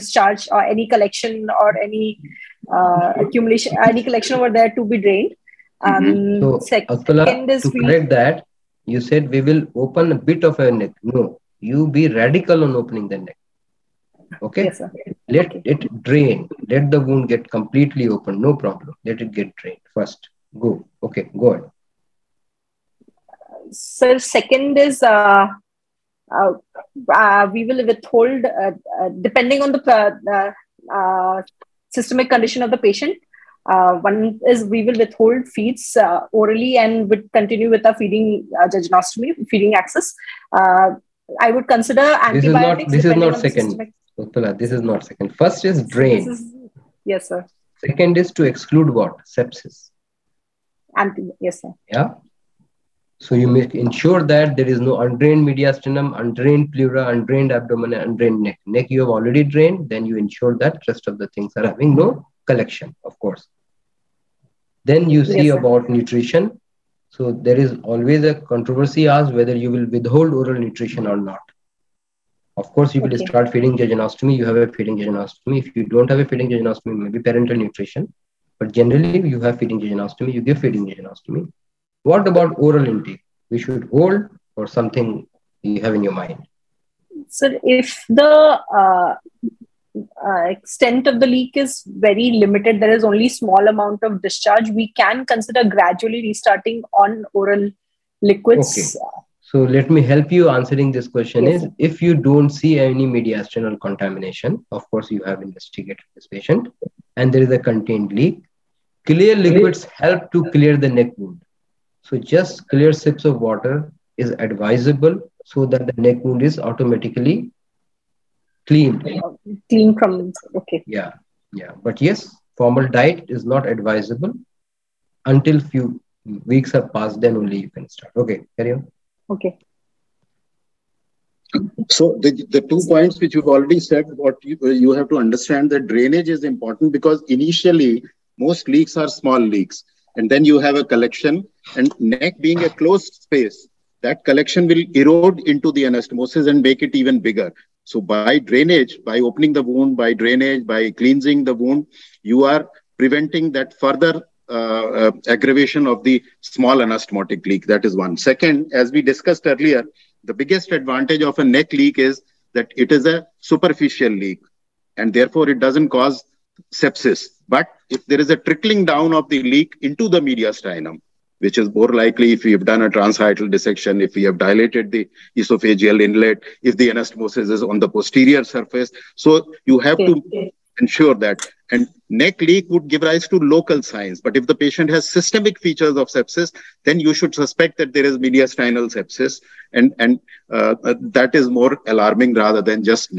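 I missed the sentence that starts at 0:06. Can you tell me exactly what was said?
Um, So, to correct that, you said we will open a bit of a neck.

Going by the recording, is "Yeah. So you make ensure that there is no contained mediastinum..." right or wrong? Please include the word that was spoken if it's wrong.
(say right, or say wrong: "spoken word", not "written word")
wrong: "undrained", not "contained".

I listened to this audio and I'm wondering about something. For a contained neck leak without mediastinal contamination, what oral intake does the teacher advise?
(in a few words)
clear sips of water.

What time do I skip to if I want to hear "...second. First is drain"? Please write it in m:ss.
0:45.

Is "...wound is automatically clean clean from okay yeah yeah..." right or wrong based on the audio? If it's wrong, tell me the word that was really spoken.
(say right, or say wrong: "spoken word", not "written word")
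right.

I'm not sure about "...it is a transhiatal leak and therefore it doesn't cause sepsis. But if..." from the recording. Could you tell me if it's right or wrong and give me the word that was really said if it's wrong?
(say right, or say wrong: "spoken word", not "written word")
wrong: "superficial", not "transhiatal".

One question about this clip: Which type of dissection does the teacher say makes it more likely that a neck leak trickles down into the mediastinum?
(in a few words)
transhiatal dissection.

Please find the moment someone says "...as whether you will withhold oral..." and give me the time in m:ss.
1:09.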